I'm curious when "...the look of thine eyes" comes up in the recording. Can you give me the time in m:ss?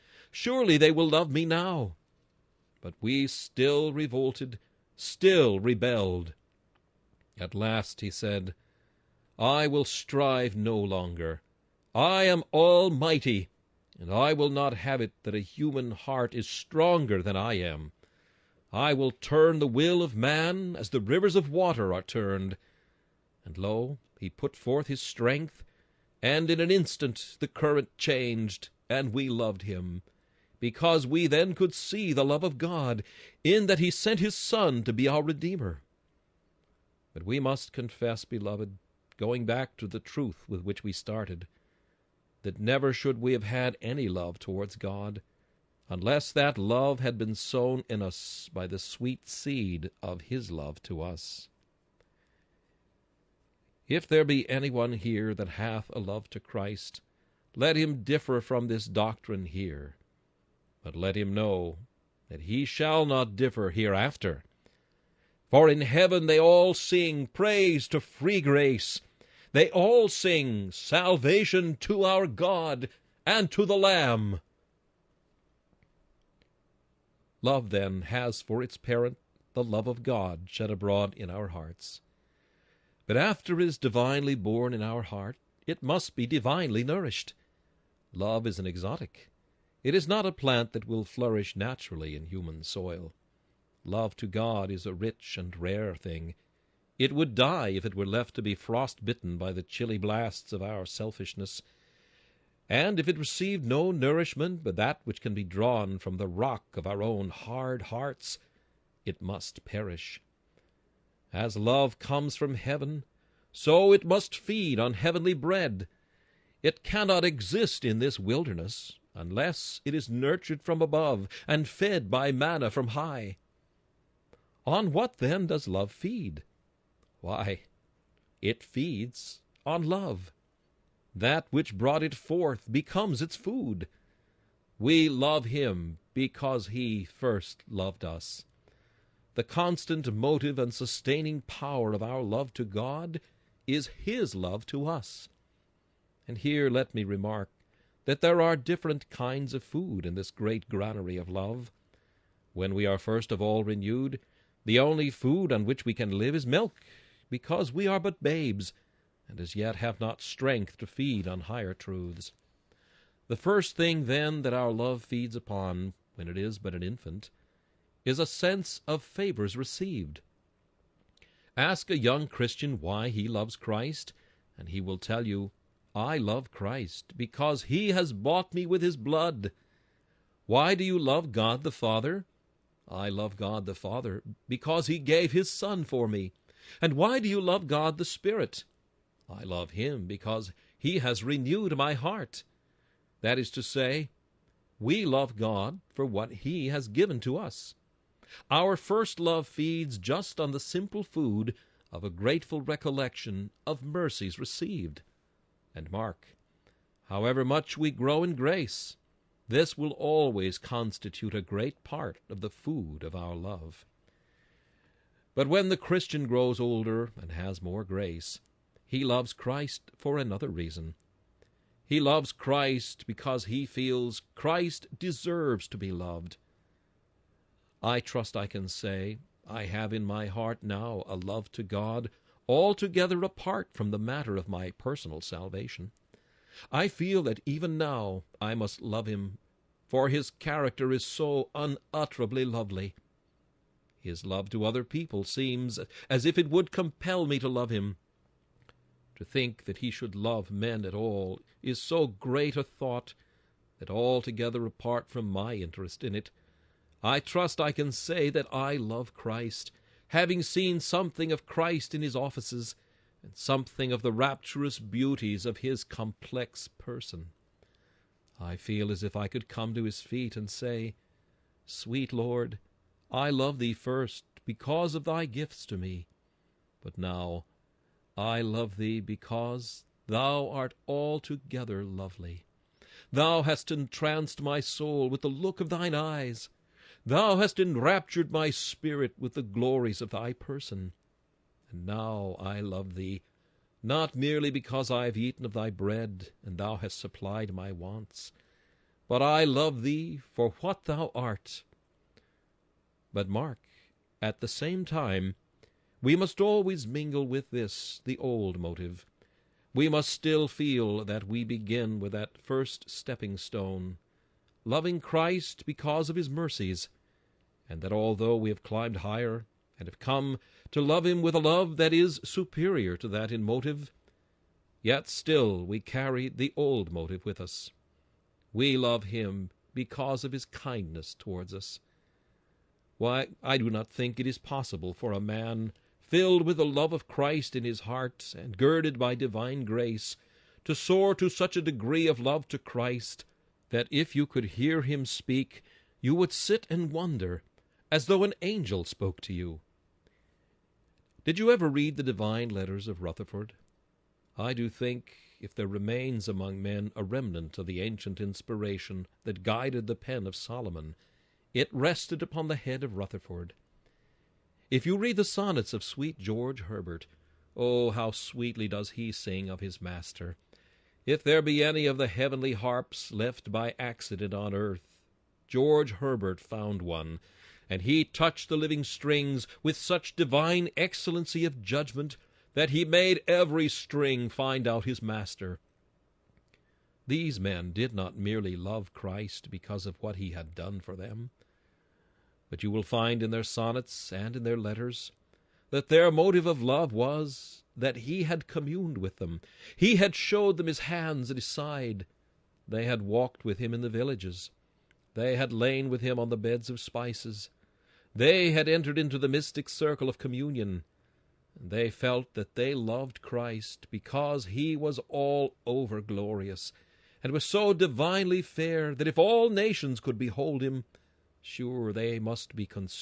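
4:45.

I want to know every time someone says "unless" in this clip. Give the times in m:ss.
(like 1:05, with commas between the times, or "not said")
0:45, 1:59.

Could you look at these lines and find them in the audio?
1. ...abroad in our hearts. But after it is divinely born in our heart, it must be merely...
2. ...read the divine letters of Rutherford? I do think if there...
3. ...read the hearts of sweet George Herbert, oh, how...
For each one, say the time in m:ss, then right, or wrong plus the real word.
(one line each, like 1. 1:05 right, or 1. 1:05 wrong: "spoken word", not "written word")
1. 1:20 wrong: "divinely", not "merely"
2. 5:51 right
3. 6:04 wrong: "sonnets", not "hearts".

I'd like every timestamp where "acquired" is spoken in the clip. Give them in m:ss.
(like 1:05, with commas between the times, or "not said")
not said.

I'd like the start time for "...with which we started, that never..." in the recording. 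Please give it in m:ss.
0:40.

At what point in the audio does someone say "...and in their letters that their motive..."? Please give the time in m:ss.
6:34.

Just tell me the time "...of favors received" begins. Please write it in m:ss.
2:48.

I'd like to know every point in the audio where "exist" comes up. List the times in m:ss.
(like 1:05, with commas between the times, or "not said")
1:57.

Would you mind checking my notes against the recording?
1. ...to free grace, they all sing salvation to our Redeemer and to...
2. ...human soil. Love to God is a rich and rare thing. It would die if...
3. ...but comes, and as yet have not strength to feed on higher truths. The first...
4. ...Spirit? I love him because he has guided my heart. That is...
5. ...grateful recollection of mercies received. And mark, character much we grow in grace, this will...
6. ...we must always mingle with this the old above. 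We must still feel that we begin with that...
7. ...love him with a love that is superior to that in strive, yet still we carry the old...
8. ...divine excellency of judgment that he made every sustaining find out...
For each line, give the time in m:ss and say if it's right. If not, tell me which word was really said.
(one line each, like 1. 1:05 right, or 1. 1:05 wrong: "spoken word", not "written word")
1. 1:07 wrong: "God", not "Redeemer"
2. 1:32 right
3. 2:37 wrong: "babes", not "comes"
4. 3:08 wrong: "renewed", not "guided"
5. 3:22 wrong: "however", not "character"
6. 5:06 wrong: "motive", not "above"
7. 5:20 wrong: "motive", not "strive"
8. 6:20 wrong: "string", not "sustaining".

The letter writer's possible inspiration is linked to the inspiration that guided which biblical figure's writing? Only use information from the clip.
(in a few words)
Solomon.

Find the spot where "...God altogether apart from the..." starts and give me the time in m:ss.
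3:51.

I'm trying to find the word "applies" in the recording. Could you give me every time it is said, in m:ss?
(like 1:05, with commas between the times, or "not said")
not said.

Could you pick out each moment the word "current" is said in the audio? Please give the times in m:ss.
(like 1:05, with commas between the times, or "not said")
0:27.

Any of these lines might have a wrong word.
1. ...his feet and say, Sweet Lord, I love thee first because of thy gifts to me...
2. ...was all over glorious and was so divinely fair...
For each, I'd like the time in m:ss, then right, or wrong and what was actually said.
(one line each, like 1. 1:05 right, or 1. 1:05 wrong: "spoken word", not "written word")
1. 4:29 right
2. 6:54 right.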